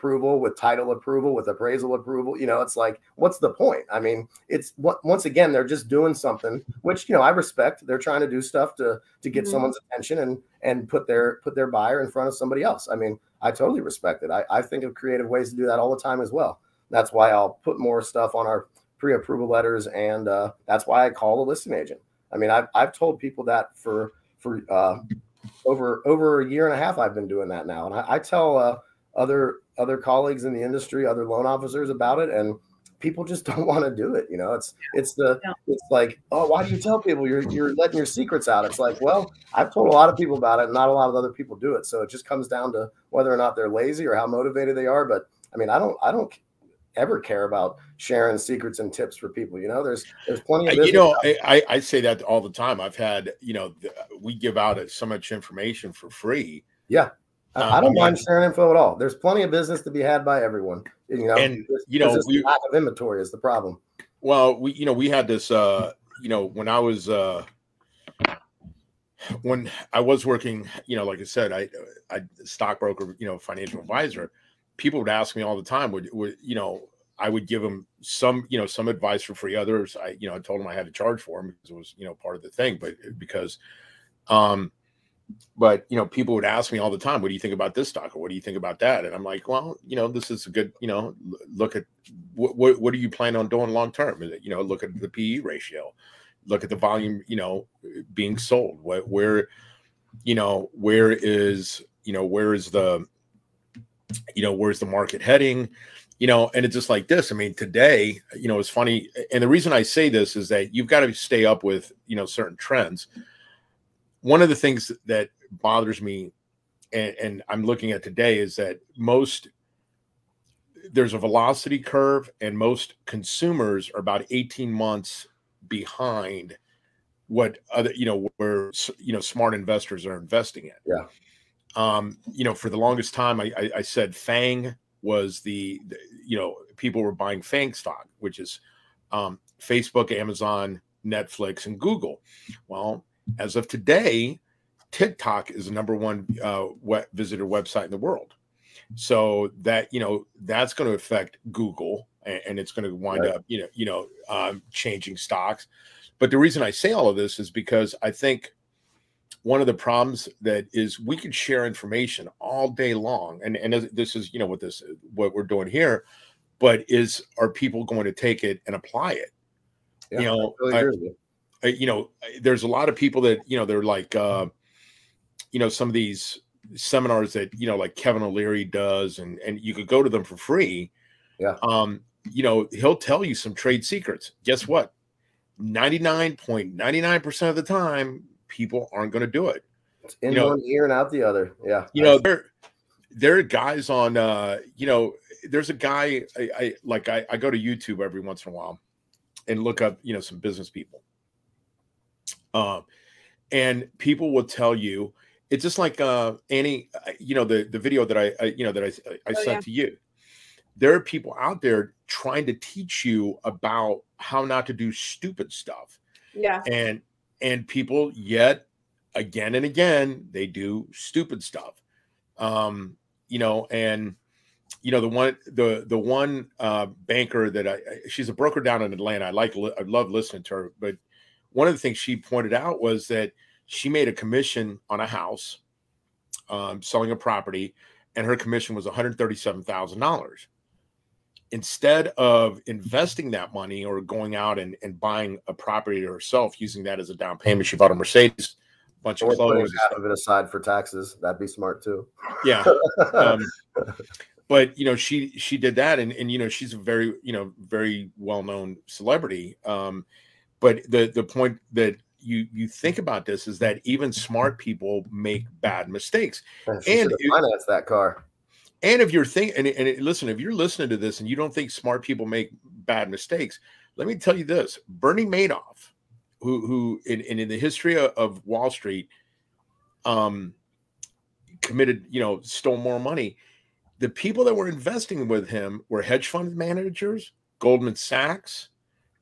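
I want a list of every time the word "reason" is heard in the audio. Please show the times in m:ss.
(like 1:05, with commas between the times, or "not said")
1:49, 2:36.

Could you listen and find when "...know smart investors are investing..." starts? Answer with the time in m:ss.
2:09.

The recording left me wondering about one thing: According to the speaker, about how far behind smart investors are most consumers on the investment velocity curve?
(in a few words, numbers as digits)
18 months.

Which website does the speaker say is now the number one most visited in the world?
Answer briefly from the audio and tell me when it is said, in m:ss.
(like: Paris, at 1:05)
TikTok, at 2:24.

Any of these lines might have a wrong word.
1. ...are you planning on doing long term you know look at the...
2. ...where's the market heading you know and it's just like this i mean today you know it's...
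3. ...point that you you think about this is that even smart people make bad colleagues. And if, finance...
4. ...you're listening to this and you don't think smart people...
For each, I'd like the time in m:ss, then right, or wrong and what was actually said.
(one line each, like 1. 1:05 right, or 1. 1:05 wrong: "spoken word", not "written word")
1. 1:32 right
2. 1:44 right
3. 4:21 wrong: "mistakes", not "colleagues"
4. 4:30 right.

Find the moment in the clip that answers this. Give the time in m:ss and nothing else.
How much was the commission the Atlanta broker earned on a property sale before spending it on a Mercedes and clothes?
3:58.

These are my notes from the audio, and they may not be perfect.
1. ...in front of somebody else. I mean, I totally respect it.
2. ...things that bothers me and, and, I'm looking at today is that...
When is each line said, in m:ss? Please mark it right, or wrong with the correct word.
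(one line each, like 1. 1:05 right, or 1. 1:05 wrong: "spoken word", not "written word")
1. 0:12 right
2. 1:54 right.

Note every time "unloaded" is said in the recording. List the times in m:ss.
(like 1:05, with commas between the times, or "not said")
not said.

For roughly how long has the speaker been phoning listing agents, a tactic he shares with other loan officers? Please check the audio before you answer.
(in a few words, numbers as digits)
a year and a half.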